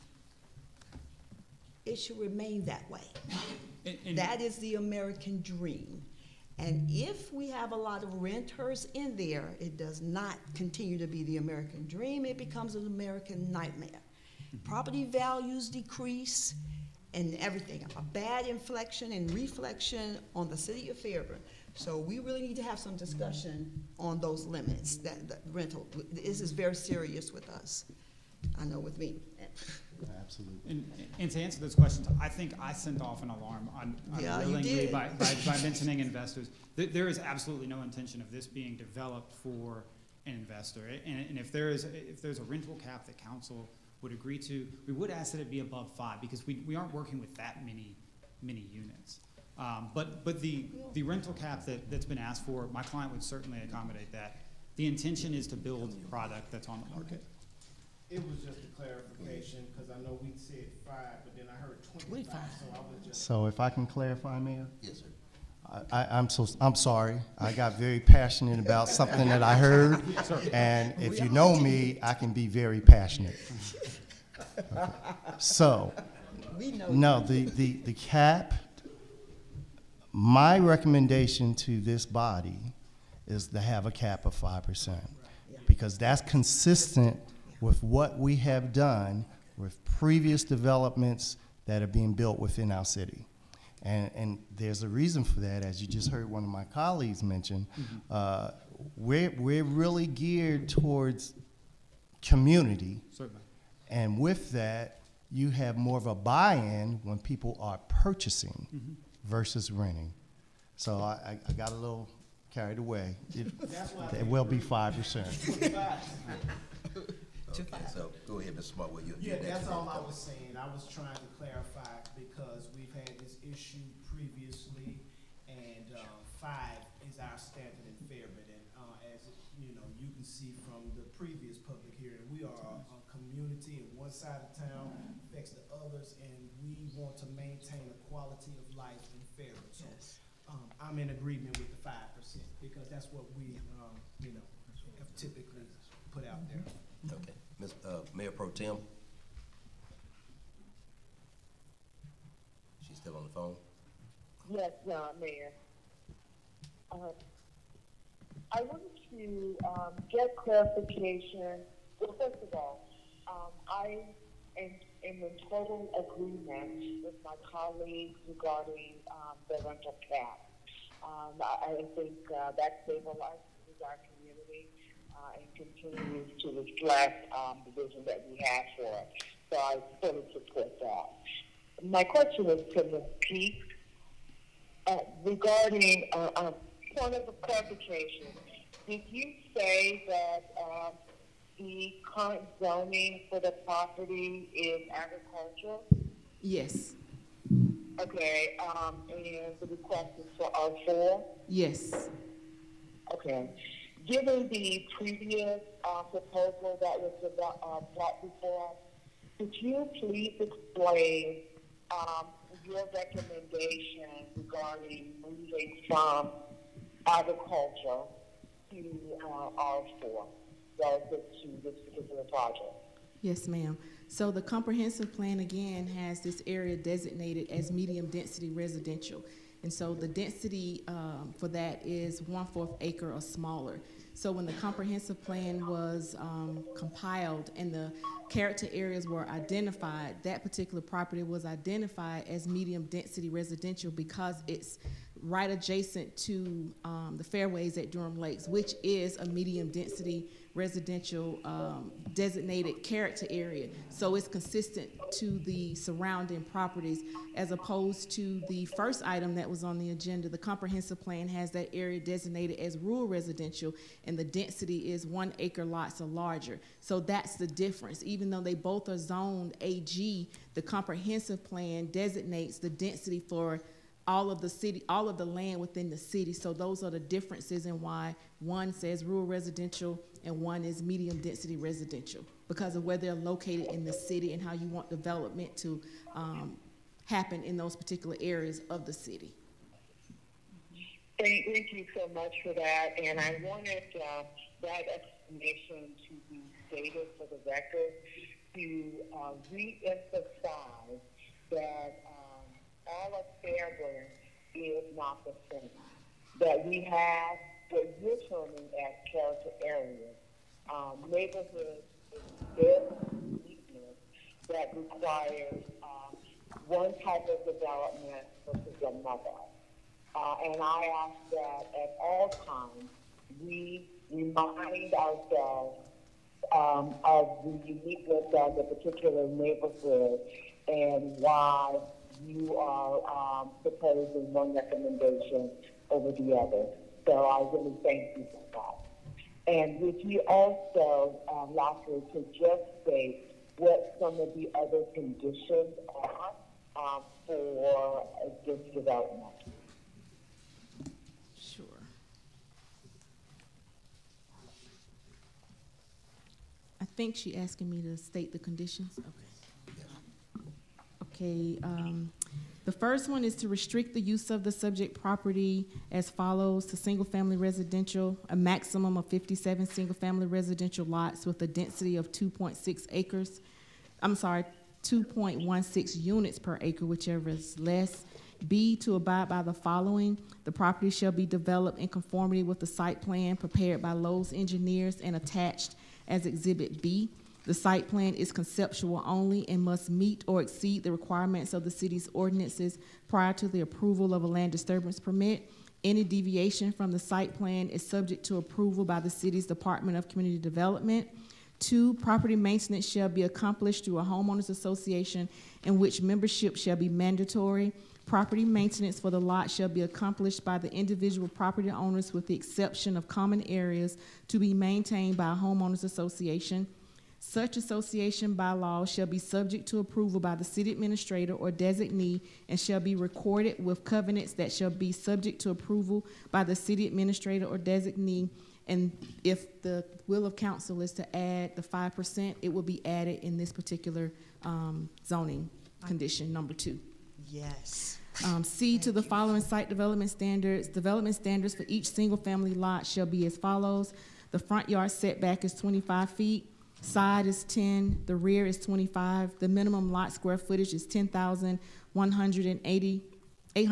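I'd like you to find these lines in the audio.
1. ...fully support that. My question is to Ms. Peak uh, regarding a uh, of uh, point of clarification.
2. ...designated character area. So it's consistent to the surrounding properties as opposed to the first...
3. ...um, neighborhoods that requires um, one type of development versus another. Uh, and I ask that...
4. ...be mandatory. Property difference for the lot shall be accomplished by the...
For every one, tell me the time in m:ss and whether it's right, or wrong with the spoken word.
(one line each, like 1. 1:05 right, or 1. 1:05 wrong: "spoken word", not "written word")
1. 2:59 right
2. 4:12 right
3. 5:10 right
4. 6:46 wrong: "maintenance", not "difference".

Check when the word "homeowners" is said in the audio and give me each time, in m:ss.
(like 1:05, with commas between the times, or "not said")
6:44, 6:55.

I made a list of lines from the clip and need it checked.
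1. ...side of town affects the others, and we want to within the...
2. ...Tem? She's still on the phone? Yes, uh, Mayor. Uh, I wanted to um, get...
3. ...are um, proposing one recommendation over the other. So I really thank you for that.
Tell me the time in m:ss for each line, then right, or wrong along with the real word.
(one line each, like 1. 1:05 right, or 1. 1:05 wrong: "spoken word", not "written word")
1. 2:14 wrong: "maintain", not "within"
2. 2:28 right
3. 5:32 right.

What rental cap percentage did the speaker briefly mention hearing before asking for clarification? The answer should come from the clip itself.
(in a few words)
25.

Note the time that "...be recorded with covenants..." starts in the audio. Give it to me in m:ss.
7:02.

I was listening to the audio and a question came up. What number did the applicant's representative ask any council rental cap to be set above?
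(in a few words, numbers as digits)
5.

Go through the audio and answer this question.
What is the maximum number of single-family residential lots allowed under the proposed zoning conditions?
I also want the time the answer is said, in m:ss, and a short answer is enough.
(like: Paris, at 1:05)
57, at 6:09.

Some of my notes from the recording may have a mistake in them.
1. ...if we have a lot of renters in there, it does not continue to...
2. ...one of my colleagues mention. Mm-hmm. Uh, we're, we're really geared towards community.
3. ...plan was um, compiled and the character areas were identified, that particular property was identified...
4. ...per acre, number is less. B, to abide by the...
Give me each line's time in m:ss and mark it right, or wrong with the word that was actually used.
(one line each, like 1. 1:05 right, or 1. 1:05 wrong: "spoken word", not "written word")
1. 0:06 right
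2. 1:36 right
3. 3:55 right
4. 6:16 wrong: "whichever", not "number".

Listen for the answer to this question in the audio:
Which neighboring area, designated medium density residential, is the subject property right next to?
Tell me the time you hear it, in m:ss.
4:07.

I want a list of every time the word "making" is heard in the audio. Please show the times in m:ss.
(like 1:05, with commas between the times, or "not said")
not said.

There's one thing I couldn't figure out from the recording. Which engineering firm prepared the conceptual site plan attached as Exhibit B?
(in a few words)
Lowe's Engineers.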